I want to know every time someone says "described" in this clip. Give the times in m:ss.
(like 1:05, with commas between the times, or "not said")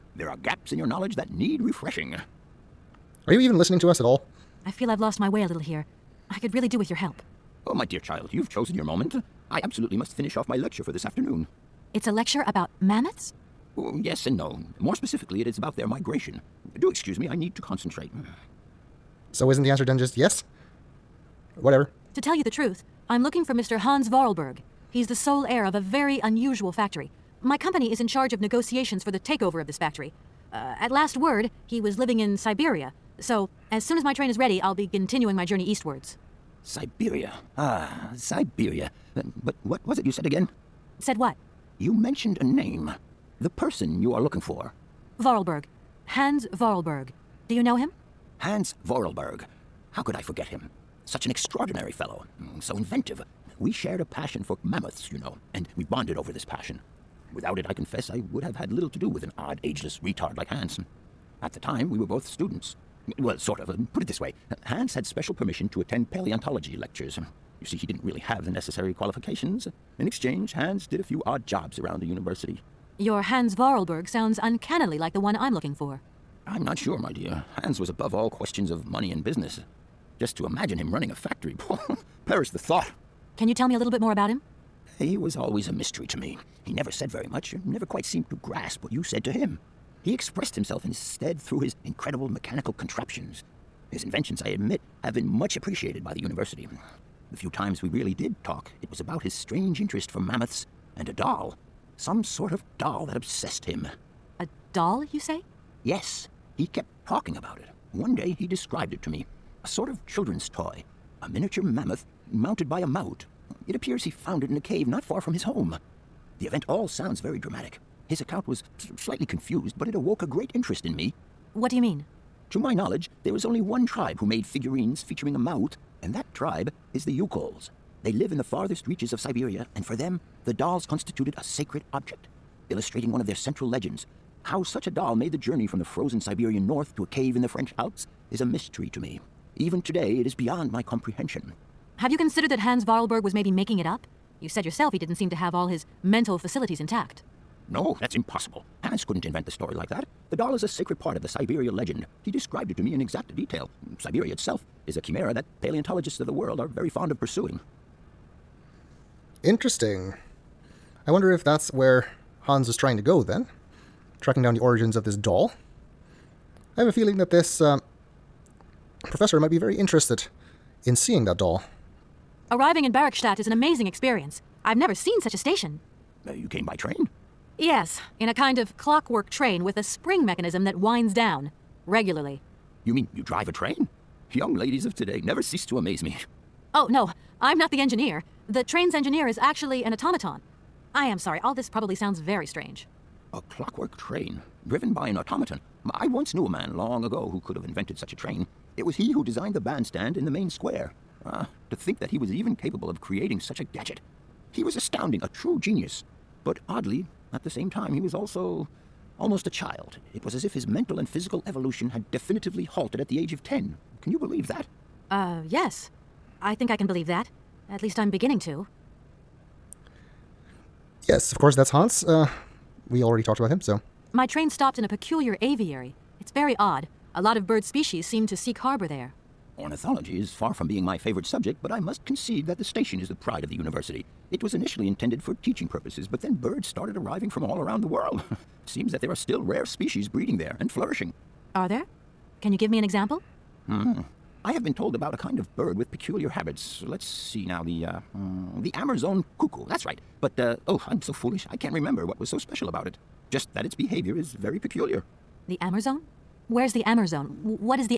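1:48, 2:32.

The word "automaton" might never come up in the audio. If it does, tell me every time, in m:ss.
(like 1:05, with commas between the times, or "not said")
3:09, 3:15.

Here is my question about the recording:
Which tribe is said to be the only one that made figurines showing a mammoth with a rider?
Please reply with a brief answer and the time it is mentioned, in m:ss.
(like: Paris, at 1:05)
Youkols, at 2:07.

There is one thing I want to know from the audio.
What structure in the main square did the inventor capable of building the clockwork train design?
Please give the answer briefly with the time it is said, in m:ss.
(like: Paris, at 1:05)
The bandstand, at 3:19.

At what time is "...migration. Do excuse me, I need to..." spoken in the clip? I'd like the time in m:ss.
0:15.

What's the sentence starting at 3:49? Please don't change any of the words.
Ornithology is far from being my favorite subject, but I must concede that the station is the pride of the university.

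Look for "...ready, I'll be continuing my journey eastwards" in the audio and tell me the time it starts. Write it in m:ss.
0:34.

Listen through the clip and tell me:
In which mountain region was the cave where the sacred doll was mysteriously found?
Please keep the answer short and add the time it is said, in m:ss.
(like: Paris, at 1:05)
French Alps, at 2:17.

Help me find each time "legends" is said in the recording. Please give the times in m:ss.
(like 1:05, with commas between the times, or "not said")
2:13, 2:31.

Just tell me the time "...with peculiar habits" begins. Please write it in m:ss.
4:05.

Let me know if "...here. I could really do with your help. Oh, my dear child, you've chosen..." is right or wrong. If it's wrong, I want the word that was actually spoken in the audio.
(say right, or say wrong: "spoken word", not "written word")
right.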